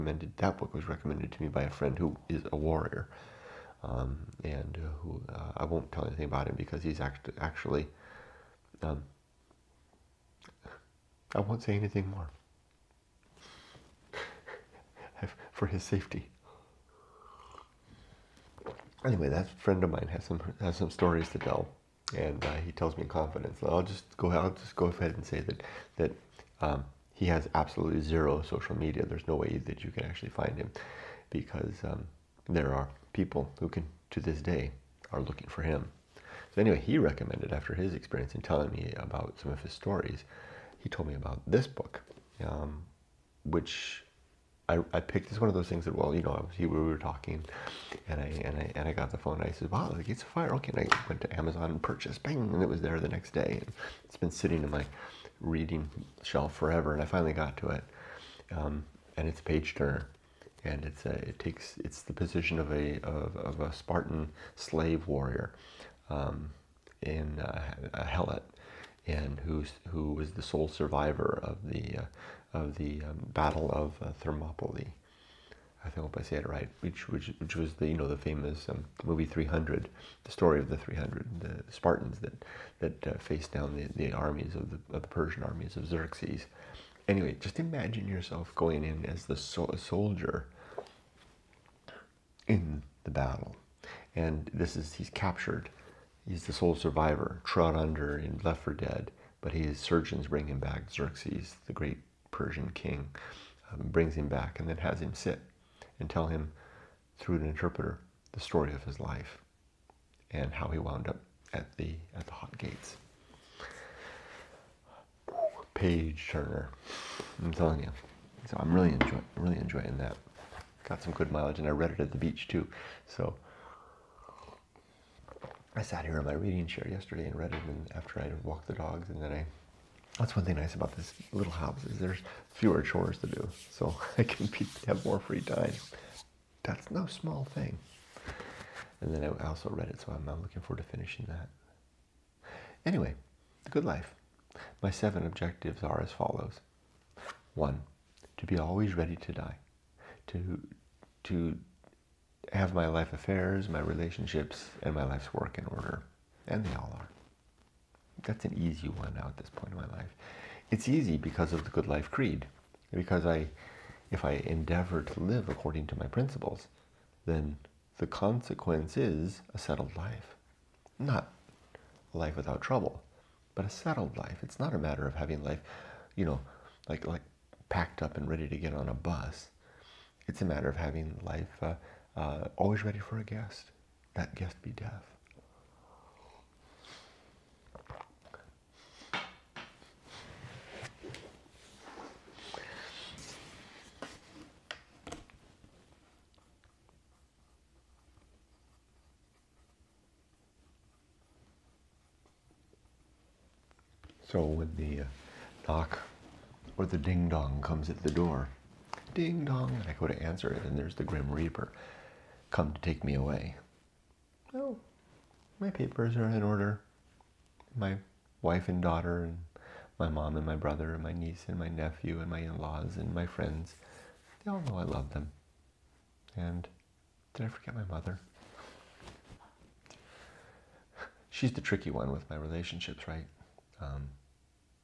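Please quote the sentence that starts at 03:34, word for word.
Oh, my papers are in order.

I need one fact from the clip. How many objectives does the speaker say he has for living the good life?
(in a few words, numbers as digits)
7.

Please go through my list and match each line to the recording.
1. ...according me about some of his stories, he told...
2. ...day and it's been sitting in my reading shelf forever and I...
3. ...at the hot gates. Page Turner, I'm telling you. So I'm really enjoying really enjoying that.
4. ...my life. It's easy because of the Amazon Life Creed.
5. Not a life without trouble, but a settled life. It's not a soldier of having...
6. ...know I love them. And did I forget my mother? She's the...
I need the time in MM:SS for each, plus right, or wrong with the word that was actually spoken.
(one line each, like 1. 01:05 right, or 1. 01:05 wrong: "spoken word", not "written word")
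1. 00:38 wrong: "telling", not "according"
2. 00:53 right
3. 01:52 right
4. 02:39 wrong: "Good", not "Amazon"
5. 02:50 wrong: "matter", not "soldier"
6. 03:44 right.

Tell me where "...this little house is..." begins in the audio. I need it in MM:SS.
02:10.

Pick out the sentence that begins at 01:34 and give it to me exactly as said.
And this is, he's captured He's the sole survivor, trod under and left for dead, but his surgeons bring him back.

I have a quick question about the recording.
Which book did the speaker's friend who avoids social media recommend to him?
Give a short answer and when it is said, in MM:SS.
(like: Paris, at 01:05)
Gates of Fire, at 00:50.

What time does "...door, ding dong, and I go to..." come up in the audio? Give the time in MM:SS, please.
03:28.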